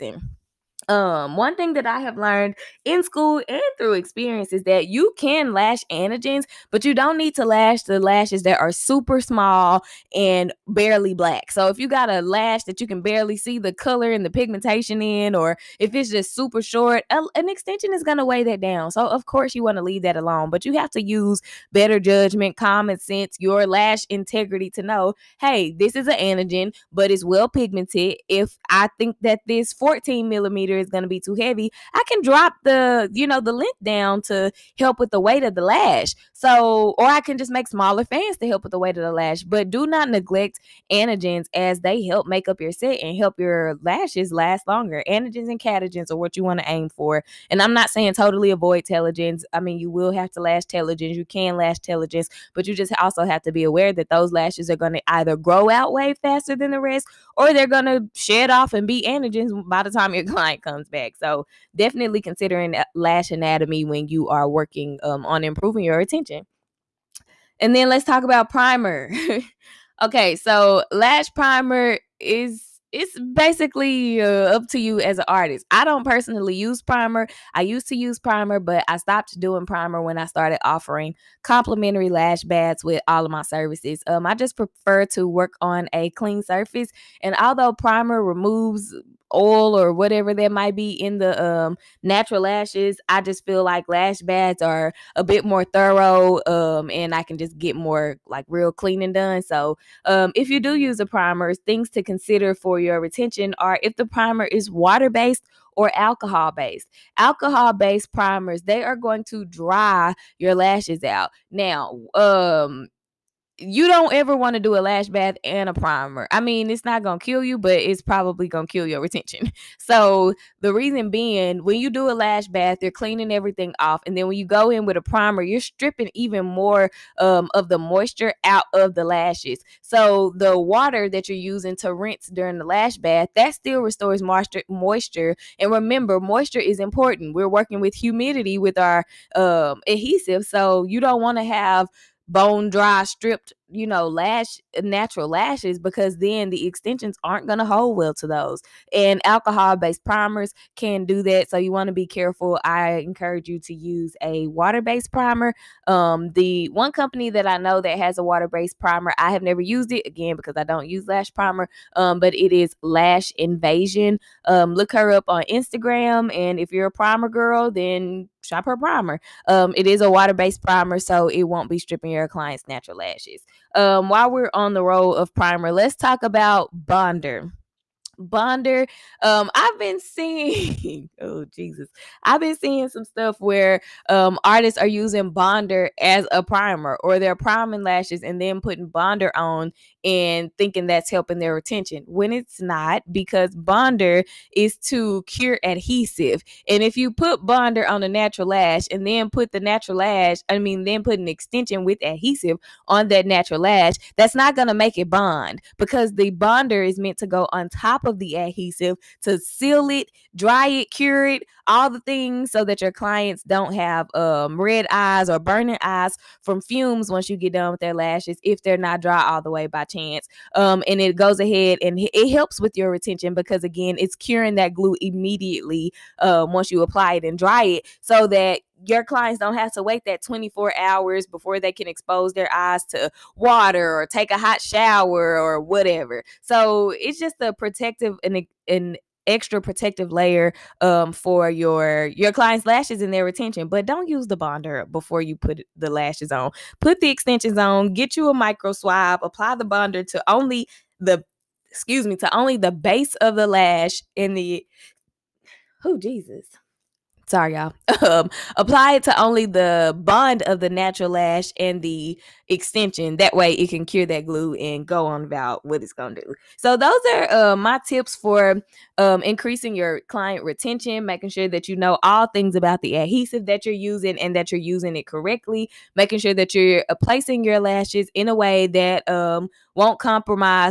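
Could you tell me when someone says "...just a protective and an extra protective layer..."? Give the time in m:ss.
3:57.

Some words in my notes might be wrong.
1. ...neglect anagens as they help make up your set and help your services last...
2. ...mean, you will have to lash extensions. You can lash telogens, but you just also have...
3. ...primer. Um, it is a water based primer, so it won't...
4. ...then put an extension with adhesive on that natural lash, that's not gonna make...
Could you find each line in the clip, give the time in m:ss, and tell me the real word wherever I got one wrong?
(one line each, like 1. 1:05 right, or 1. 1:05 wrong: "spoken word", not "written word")
1. 0:40 wrong: "lashes", not "services"
2. 0:49 wrong: "telogens", not "extensions"
3. 2:48 right
4. 3:20 right.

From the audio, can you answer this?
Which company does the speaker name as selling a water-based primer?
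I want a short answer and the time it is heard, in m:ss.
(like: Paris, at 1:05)
Lash Invasion, at 2:42.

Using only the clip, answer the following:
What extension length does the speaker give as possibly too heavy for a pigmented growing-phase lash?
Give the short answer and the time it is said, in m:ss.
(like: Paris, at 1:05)
14 millimeter, at 0:29.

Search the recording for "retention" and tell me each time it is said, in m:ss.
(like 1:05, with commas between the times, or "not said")
1:42, 1:59, 3:11, 3:42, 4:03, 4:30.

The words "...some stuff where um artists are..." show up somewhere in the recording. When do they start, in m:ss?
3:02.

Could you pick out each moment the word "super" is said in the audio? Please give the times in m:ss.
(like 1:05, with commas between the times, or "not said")
0:08, 0:16.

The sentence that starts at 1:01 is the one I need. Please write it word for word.
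So definitely considering lash anatomy when you are working um, on improving your attention.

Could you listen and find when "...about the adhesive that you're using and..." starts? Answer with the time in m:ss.
4:32.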